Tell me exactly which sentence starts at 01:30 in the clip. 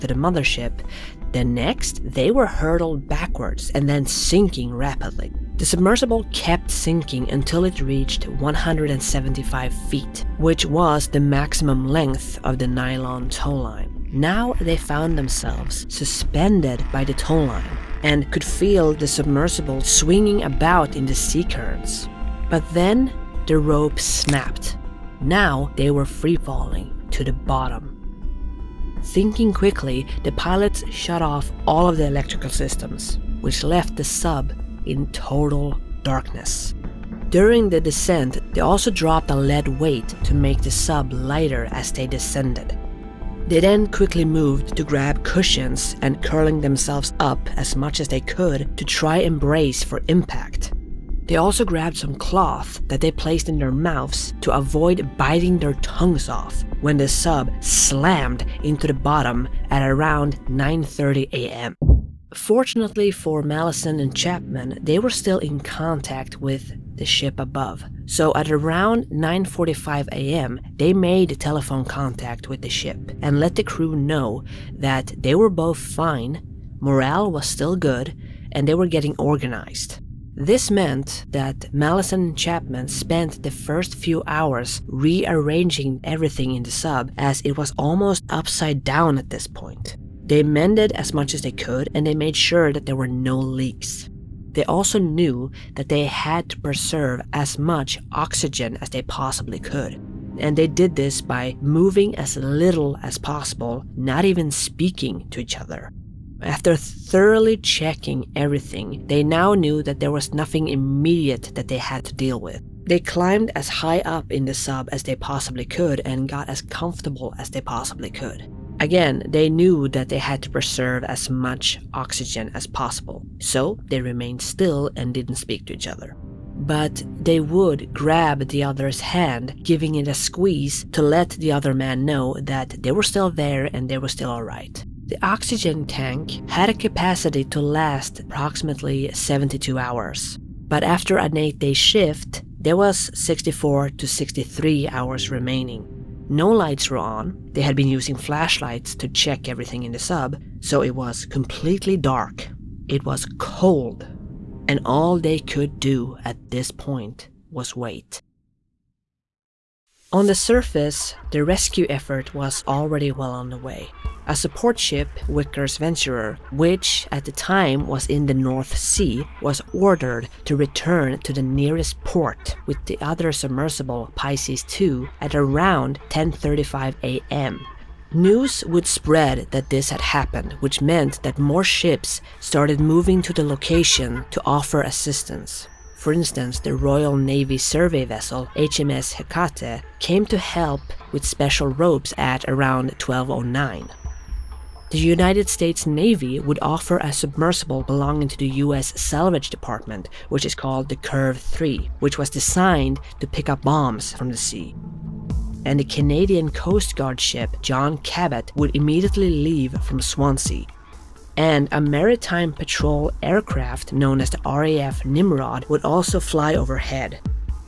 They mended as much as they could and they made sure that there were no leaks.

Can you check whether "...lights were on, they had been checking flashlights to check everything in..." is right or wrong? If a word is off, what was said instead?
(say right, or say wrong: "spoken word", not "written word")
wrong: "using", not "checking".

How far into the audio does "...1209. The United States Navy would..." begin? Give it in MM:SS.
03:13.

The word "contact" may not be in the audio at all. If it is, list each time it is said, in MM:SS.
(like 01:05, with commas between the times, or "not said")
01:05, 01:11.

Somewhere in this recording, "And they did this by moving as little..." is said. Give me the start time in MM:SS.
01:40.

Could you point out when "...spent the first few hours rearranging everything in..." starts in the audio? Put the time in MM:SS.
01:22.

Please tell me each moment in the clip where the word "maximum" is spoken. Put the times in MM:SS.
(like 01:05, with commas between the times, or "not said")
00:11.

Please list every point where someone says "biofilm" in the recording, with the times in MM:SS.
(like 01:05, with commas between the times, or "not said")
not said.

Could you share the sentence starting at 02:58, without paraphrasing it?
News would spread that this had happened, which meant that more ships started moving to the location to offer assistance.